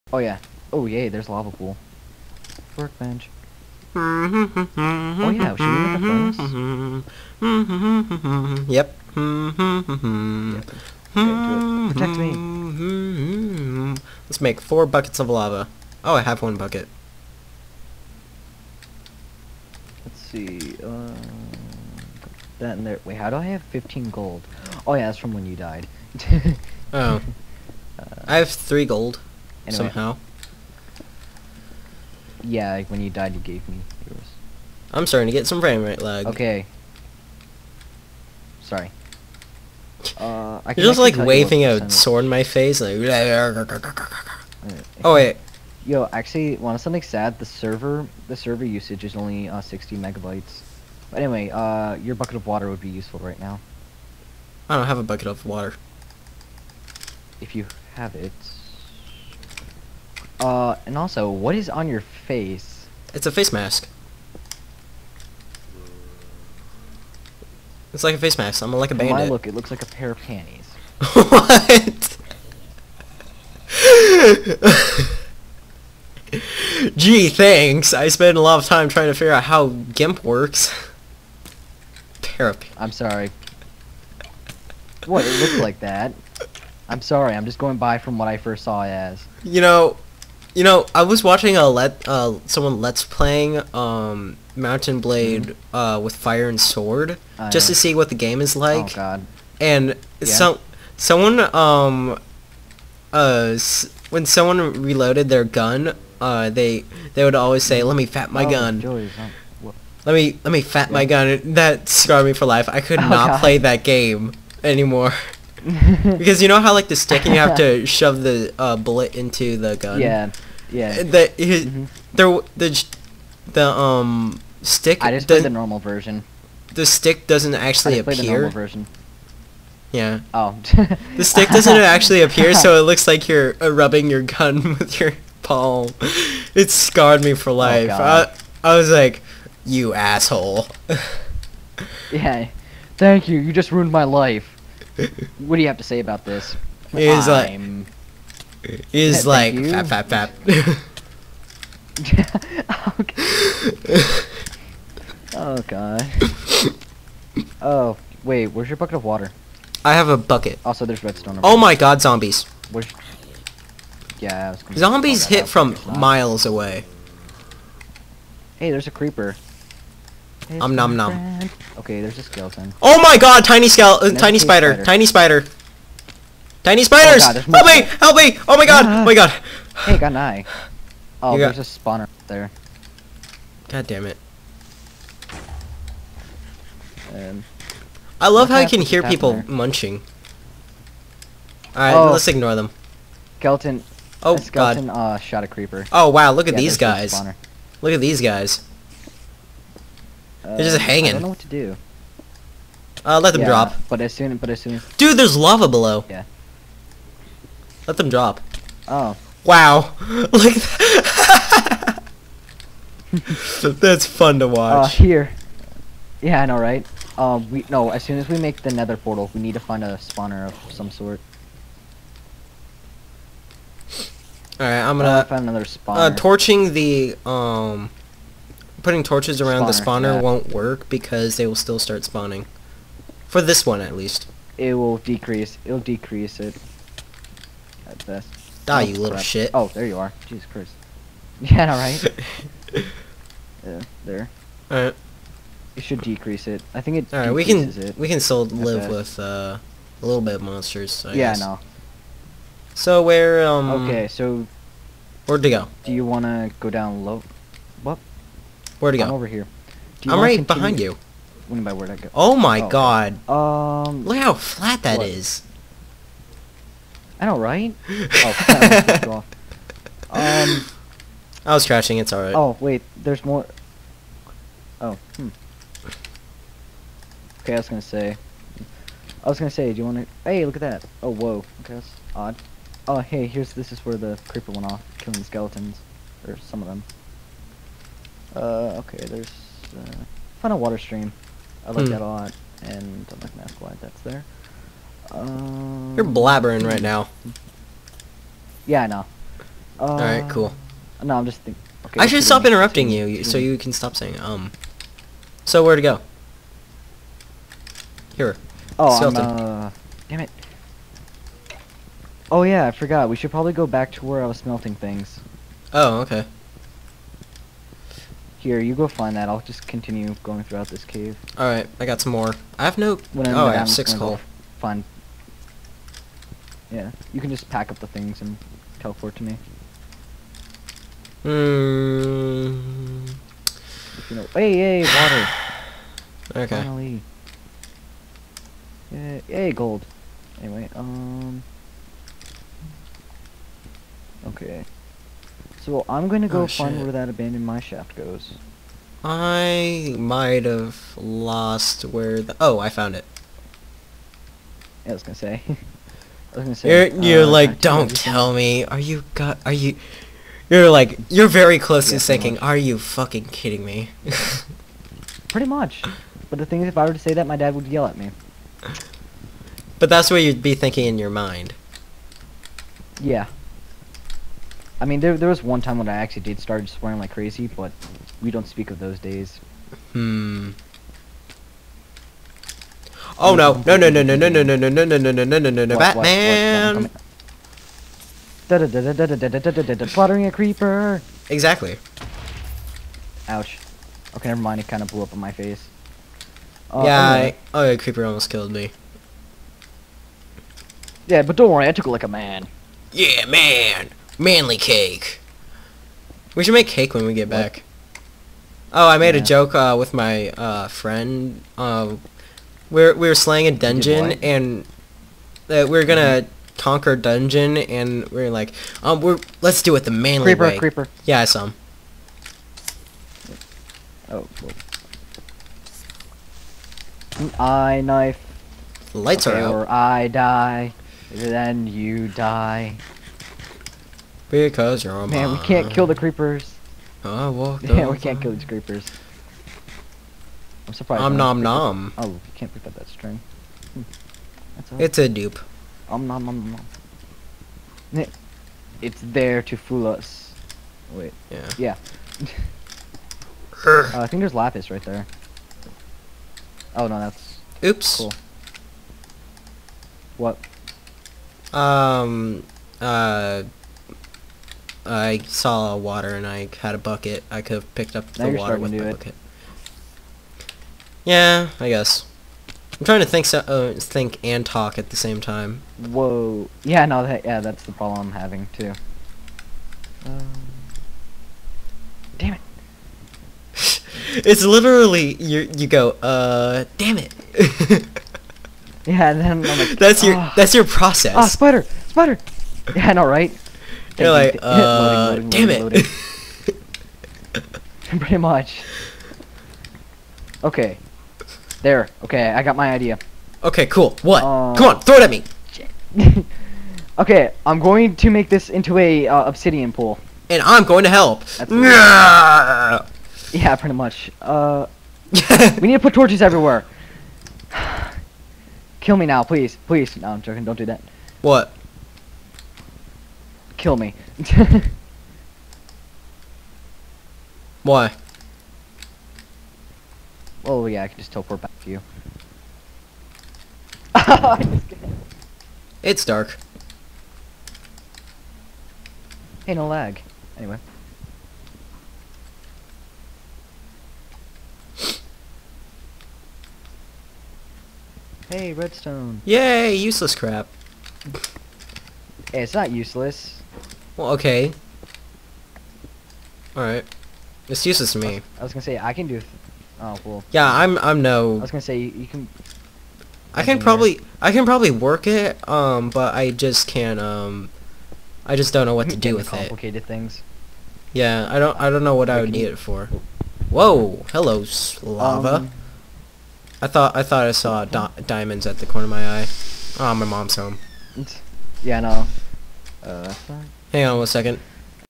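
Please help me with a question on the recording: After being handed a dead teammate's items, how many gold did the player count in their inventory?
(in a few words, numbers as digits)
15.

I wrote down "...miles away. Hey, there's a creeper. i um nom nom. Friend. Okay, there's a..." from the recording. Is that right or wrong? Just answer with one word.
right.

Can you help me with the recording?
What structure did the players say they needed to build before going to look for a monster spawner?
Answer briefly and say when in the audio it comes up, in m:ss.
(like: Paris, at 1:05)
Nether portal, at 3:38.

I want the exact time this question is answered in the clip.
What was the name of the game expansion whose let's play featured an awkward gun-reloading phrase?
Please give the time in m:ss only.
1:35.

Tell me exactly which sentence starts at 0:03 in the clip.
oh yeah, should we make a furnace?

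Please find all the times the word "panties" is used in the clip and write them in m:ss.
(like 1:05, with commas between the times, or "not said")
1:10, 1:22.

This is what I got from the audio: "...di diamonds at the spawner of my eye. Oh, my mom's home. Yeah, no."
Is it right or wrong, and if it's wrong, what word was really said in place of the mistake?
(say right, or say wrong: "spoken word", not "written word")
wrong: "corner", not "spawner".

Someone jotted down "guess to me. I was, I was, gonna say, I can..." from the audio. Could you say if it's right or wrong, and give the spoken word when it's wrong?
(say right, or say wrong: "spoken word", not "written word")
wrong: "useless", not "guess".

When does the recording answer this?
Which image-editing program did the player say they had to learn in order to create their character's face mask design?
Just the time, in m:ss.
1:19.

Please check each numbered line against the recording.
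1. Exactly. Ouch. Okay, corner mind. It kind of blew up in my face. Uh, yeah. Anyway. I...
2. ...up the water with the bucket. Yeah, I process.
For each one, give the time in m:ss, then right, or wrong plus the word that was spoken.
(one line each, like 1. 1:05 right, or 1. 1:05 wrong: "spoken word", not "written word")
1. 6:31 wrong: "never", not "corner"
2. 7:47 wrong: "guess", not "process".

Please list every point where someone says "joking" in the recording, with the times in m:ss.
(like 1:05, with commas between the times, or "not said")
8:40.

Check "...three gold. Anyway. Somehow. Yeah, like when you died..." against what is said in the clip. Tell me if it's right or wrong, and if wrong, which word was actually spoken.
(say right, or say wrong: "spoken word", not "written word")
right.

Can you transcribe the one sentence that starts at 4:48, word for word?
Uh, okay, there's uh, a Water Stream.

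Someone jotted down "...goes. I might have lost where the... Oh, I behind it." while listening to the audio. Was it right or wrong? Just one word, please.
wrong.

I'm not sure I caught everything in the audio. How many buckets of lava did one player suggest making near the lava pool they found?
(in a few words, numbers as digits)
4.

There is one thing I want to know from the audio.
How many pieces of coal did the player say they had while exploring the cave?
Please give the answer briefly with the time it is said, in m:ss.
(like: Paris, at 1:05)
6, at 5:23.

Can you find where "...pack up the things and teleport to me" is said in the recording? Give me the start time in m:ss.
5:27.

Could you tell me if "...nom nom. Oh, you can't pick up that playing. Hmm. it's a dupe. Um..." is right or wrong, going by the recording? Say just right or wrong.
wrong.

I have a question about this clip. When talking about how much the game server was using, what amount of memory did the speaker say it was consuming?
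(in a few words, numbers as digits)
60 megabytes.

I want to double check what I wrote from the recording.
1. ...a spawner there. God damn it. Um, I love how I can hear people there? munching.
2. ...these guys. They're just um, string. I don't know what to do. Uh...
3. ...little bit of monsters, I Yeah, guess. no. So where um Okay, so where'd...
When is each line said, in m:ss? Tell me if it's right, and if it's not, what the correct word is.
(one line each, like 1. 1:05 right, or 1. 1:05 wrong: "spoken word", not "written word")
1. 3:01 right
2. 3:18 wrong: "hanging", not "string"
3. 4:10 right.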